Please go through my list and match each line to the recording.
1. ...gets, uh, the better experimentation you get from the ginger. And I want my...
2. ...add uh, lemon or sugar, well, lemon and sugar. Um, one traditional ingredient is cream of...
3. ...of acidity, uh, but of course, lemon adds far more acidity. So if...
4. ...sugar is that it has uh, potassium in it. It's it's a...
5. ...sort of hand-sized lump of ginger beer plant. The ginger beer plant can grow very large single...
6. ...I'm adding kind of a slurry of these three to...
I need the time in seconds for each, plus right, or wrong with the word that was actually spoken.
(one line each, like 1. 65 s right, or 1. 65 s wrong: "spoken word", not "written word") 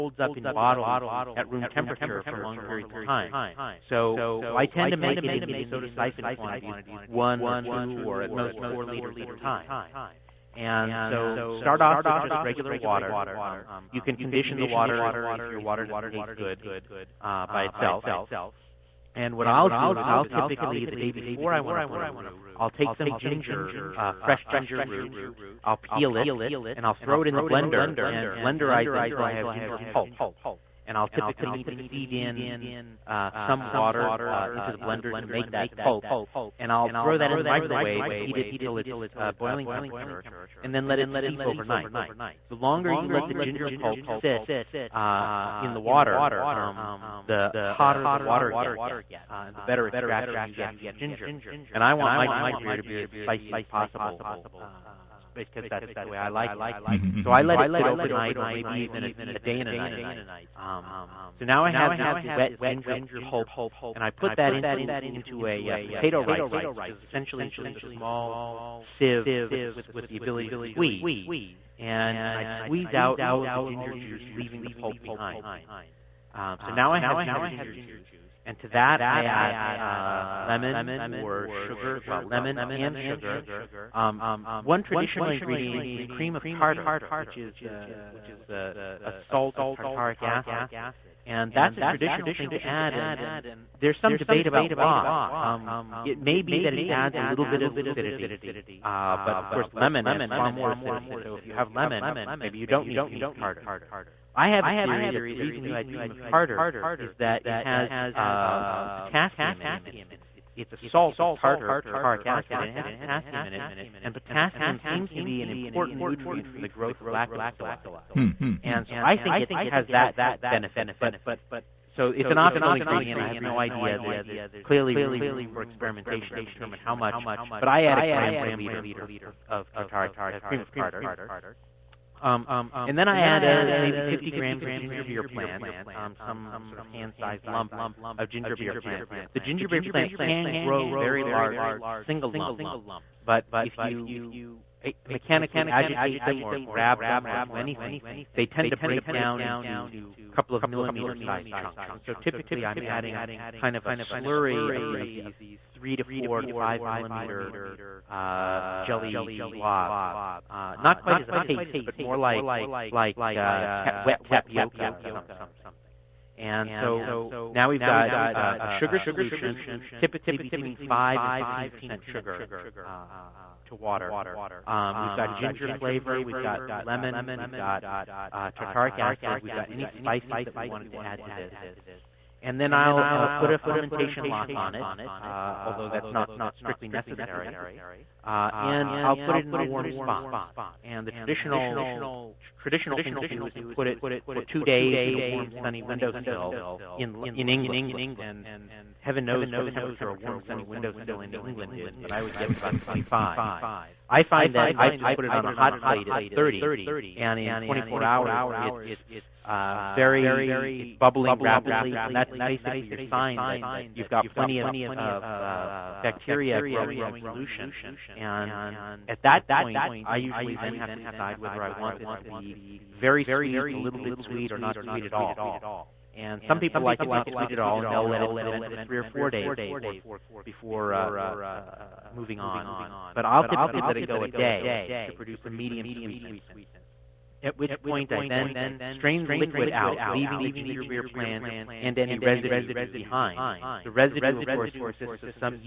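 1. 48 s wrong: "extraction", not "experimentation"
2. 79 s right
3. 97 s right
4. 106 s wrong: "tartar", not "sugar"
5. 136 s right
6. 152 s right.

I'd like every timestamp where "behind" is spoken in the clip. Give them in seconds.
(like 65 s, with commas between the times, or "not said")
75 s, 242 s.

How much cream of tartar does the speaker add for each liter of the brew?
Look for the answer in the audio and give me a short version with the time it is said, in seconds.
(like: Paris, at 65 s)
1 gram per liter, at 127 s.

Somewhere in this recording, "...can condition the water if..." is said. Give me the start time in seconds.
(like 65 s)
14 s.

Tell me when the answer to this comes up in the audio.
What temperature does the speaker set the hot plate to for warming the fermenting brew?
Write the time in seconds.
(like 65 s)
206 s.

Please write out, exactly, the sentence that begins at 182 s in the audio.
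And then I'll uh, put a fermentation lock on it, uh, although that's not strictly necessary.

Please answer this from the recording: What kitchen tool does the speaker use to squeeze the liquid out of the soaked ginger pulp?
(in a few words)
potato ricer.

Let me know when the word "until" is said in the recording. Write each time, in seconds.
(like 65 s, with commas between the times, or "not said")
29 s, 38 s.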